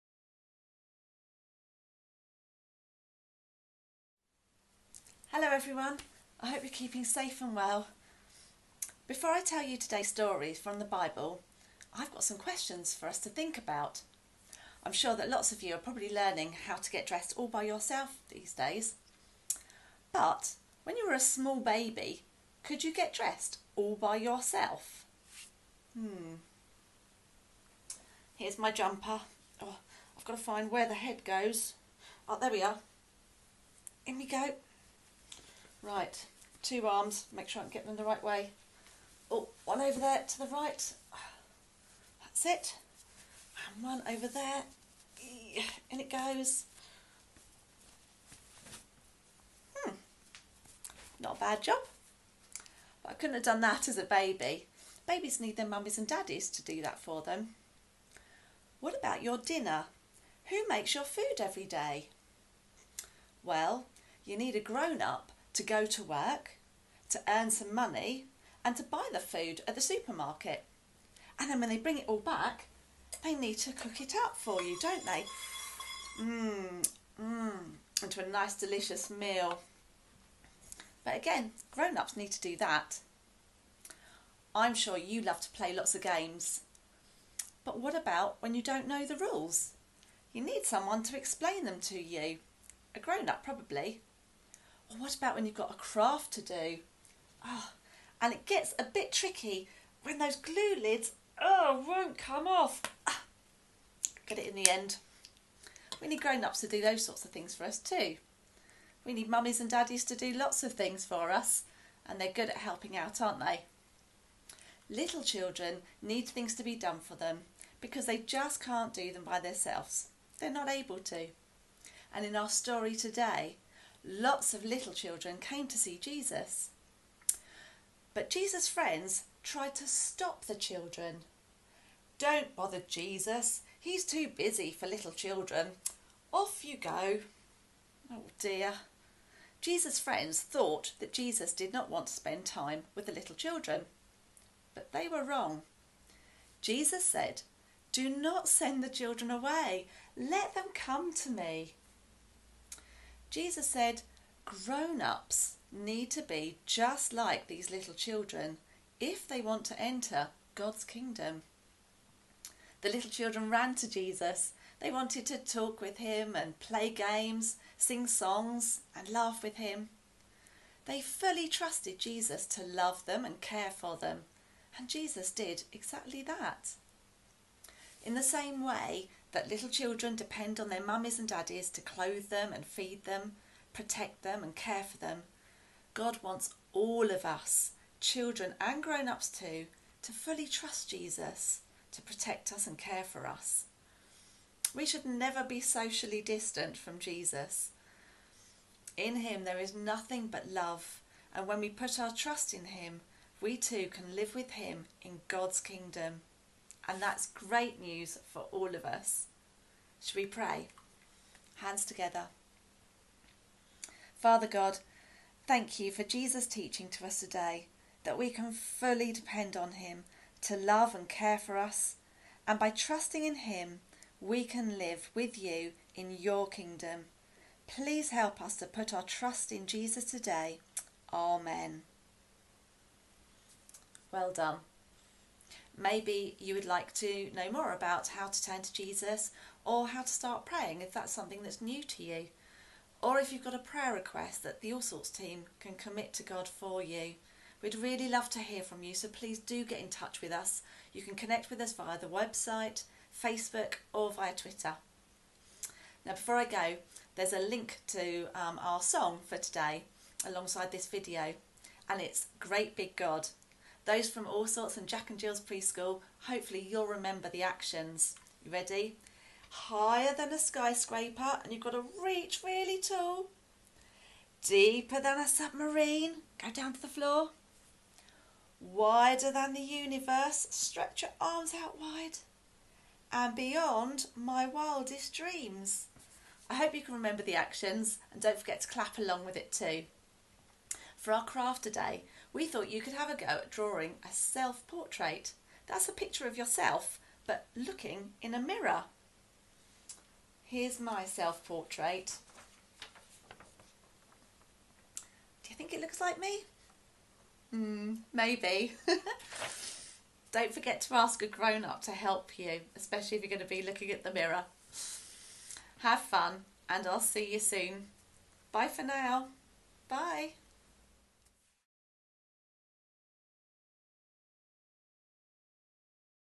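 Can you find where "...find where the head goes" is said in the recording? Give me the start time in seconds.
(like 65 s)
30 s.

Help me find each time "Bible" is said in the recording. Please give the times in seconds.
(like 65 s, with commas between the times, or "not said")
10 s.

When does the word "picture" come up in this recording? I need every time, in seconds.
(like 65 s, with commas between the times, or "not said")
295 s.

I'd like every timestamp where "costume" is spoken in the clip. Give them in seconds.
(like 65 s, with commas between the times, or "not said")
not said.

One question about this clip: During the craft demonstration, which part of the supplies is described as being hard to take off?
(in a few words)
Glue lids.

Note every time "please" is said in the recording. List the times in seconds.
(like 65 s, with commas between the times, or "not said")
227 s, 249 s.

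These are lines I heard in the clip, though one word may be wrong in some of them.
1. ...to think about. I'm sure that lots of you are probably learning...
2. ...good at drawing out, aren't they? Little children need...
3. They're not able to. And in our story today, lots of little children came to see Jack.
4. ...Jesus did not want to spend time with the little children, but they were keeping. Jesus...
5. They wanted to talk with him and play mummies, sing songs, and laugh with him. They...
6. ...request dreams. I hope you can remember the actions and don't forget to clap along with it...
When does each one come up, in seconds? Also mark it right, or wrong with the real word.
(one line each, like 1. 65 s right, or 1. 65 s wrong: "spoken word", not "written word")
1. 13 s right
2. 112 s wrong: "helping", not "drawing"
3. 120 s wrong: "Jesus", not "Jack"
4. 141 s wrong: "wrong", not "keeping"
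5. 164 s wrong: "games", not "mummies"
6. 284 s wrong: "wildest", not "request".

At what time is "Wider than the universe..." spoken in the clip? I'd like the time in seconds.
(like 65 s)
278 s.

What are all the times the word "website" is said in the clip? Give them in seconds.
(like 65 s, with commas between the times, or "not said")
252 s.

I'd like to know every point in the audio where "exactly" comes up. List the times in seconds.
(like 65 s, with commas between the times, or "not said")
175 s.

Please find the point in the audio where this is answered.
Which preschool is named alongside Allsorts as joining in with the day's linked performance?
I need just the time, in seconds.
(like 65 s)
264 s.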